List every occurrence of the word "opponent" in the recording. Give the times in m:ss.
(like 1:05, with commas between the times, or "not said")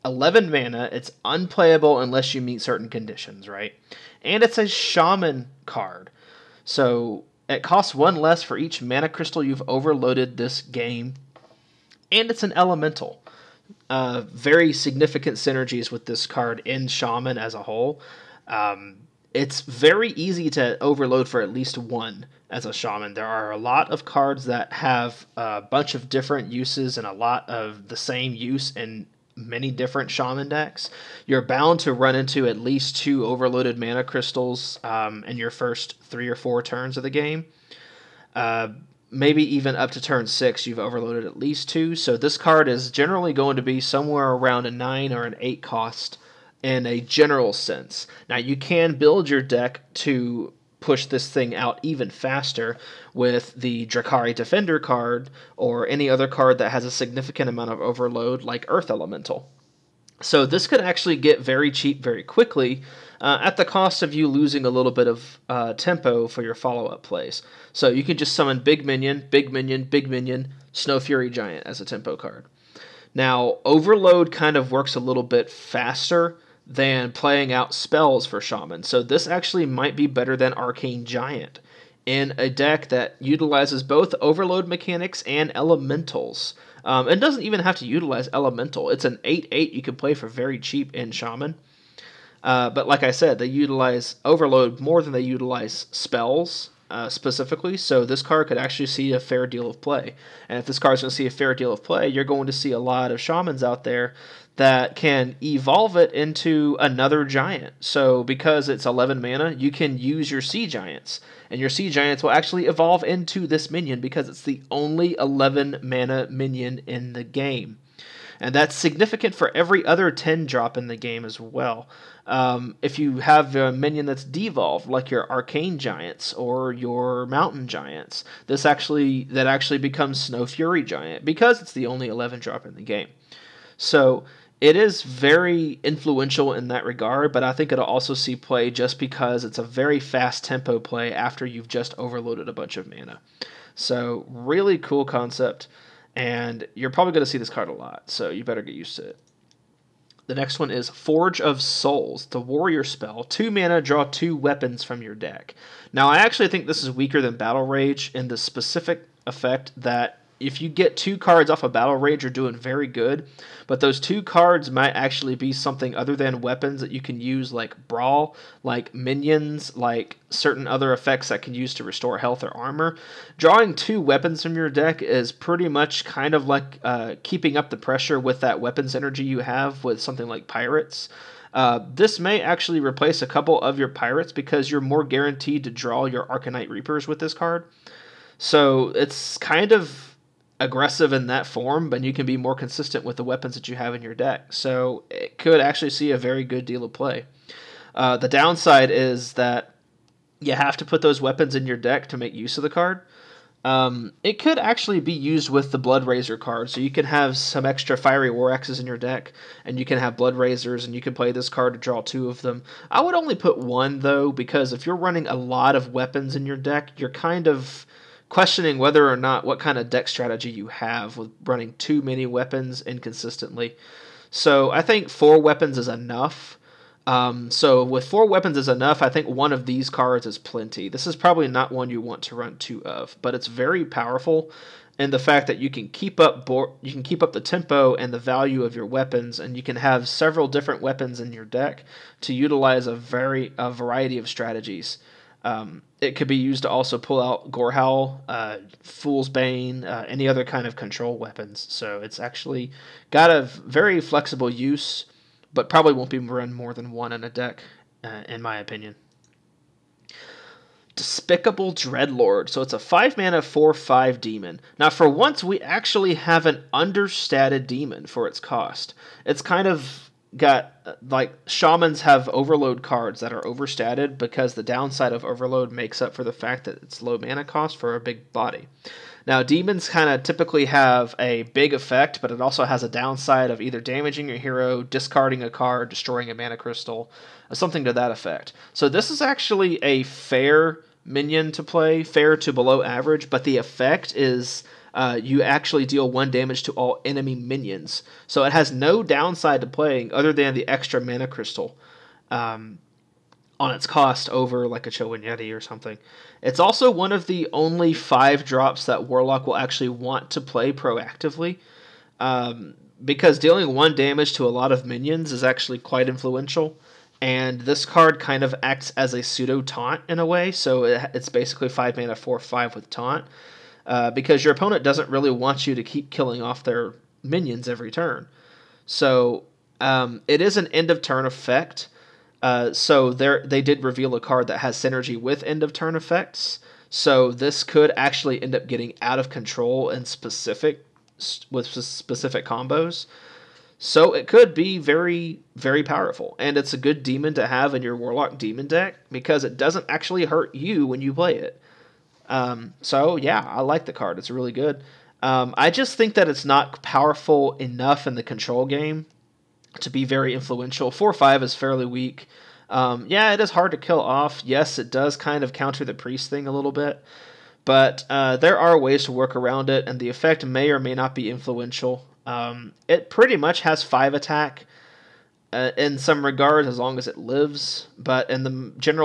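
5:24.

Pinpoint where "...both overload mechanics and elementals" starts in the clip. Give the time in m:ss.
1:23.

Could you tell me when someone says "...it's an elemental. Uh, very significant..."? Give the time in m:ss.
0:12.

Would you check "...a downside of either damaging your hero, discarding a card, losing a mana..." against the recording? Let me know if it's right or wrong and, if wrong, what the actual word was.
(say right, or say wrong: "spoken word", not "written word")
wrong: "destroying", not "losing".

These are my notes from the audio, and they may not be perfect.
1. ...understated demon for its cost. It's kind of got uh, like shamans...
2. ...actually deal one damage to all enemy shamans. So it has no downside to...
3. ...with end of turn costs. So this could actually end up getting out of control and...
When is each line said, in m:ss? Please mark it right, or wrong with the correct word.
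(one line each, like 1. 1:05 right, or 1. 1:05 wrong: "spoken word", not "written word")
1. 4:26 right
2. 4:55 wrong: "minions", not "shamans"
3. 5:35 wrong: "effects", not "costs".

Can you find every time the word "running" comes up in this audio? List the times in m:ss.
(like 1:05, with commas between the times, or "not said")
3:34, 3:41.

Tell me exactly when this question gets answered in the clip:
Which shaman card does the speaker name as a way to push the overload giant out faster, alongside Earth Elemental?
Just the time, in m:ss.
0:53.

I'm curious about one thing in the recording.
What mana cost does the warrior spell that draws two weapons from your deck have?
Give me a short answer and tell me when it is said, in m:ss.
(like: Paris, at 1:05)
2, at 2:33.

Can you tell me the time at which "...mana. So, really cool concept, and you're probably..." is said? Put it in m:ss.
2:22.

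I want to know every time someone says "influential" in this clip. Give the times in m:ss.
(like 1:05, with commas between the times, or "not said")
2:15, 5:16, 6:00, 6:11.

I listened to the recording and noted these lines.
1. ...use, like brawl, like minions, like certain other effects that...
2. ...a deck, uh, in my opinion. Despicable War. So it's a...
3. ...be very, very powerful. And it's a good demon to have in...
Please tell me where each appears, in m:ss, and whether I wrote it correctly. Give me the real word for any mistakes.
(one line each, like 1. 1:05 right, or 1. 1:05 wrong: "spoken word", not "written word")
1. 2:47 right
2. 4:17 wrong: "Dreadlord", not "War"
3. 5:44 right.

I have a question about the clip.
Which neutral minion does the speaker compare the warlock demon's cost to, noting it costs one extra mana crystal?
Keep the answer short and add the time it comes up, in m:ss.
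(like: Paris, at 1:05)
Chillwind Yeti, at 5:04.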